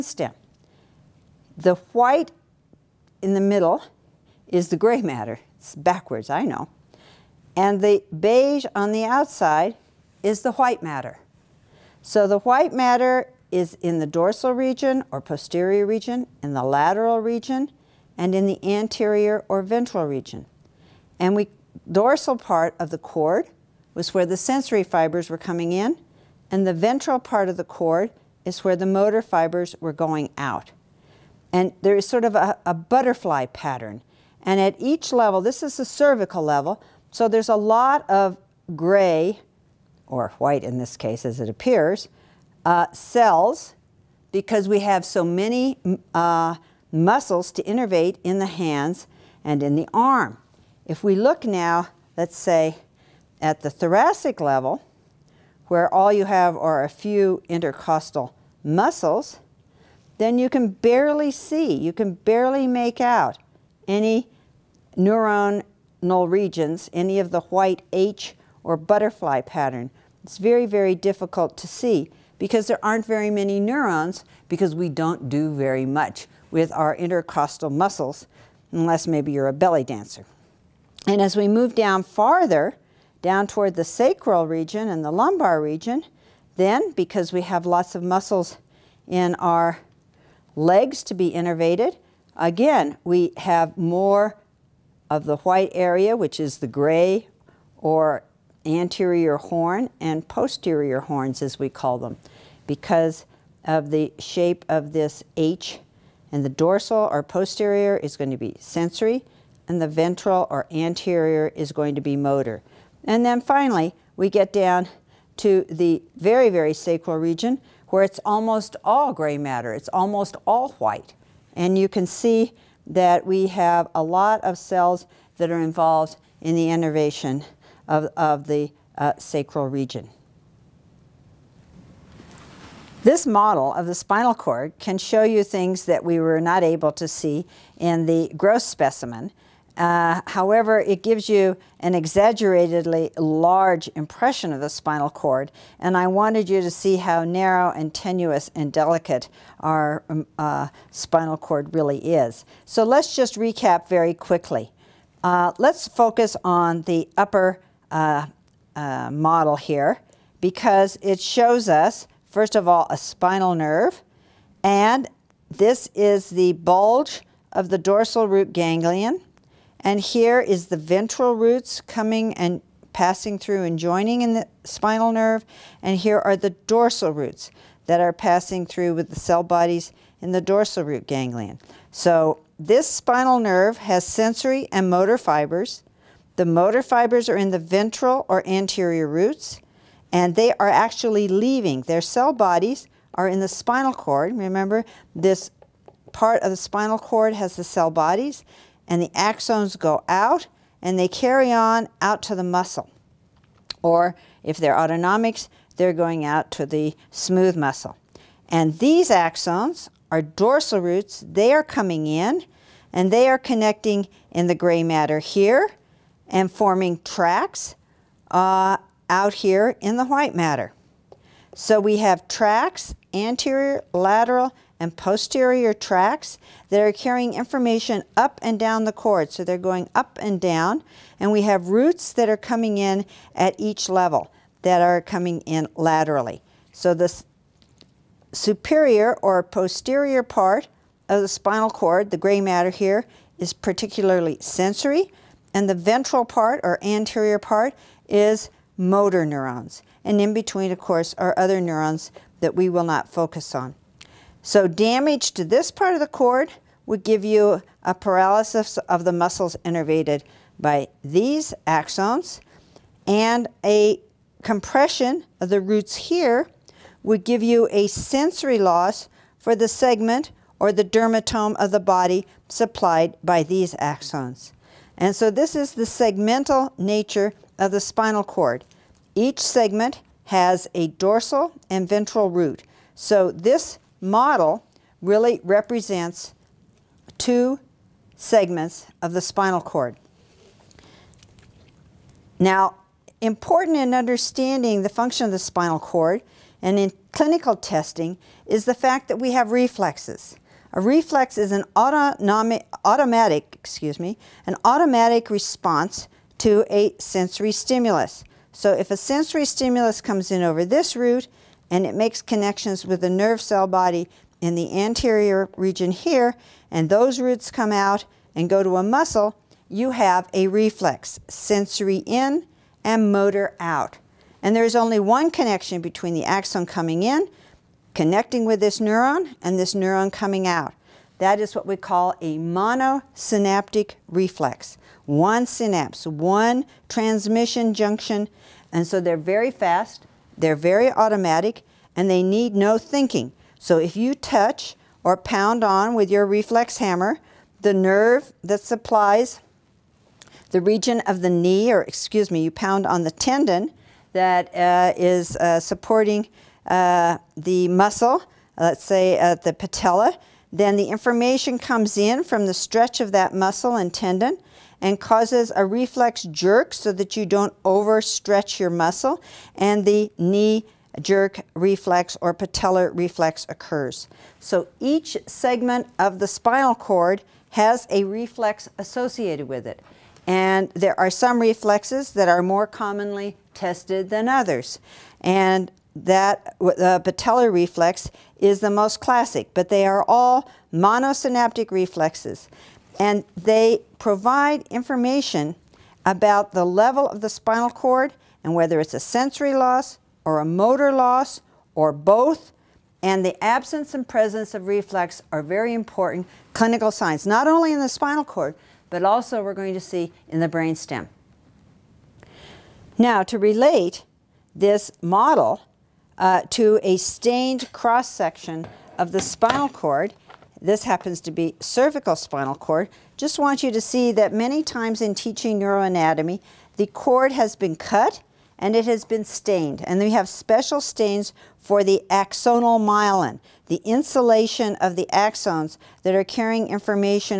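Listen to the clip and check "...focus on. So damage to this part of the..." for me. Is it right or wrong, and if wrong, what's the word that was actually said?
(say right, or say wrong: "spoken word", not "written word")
right.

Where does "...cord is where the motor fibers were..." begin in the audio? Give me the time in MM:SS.
00:27.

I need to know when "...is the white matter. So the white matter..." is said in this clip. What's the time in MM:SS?
00:10.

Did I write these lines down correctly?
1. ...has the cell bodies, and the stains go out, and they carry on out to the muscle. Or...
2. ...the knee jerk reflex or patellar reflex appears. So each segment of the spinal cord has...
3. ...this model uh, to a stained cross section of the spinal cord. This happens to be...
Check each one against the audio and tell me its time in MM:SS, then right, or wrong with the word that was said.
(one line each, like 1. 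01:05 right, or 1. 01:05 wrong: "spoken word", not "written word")
1. 03:17 wrong: "axons", not "stains"
2. 06:09 wrong: "occurs", not "appears"
3. 06:54 right.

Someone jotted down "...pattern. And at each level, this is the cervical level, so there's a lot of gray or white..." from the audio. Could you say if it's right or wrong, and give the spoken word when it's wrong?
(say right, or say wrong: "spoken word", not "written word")
right.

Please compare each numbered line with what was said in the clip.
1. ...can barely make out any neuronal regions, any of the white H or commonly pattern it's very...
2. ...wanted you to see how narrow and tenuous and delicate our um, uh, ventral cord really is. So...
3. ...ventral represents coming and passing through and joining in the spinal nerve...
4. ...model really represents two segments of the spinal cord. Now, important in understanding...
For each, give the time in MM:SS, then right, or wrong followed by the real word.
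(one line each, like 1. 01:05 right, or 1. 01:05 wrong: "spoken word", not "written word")
1. 01:01 wrong: "butterfly", not "commonly"
2. 02:26 wrong: "spinal", not "ventral"
3. 02:50 wrong: "roots", not "represents"
4. 04:44 right.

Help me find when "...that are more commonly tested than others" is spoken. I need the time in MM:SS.
06:22.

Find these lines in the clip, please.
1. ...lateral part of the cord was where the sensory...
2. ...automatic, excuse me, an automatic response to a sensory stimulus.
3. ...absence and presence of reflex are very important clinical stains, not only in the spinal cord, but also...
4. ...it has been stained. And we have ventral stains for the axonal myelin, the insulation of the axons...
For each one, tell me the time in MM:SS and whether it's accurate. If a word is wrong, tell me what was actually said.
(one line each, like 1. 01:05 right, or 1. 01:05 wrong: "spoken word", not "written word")
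1. 00:21 wrong: "dorsal", not "lateral"
2. 05:02 right
3. 06:43 wrong: "signs", not "stains"
4. 07:08 wrong: "special", not "ventral".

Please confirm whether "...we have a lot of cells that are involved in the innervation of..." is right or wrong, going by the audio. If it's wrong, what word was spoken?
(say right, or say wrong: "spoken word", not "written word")
right.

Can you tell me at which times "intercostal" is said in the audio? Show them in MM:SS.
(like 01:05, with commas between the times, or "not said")
00:57, 01:16.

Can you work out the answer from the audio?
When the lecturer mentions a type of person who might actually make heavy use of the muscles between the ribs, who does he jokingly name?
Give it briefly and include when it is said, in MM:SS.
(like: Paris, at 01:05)
a belly dancer, at 01:19.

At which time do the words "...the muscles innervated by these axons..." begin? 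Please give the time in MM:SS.
04:19.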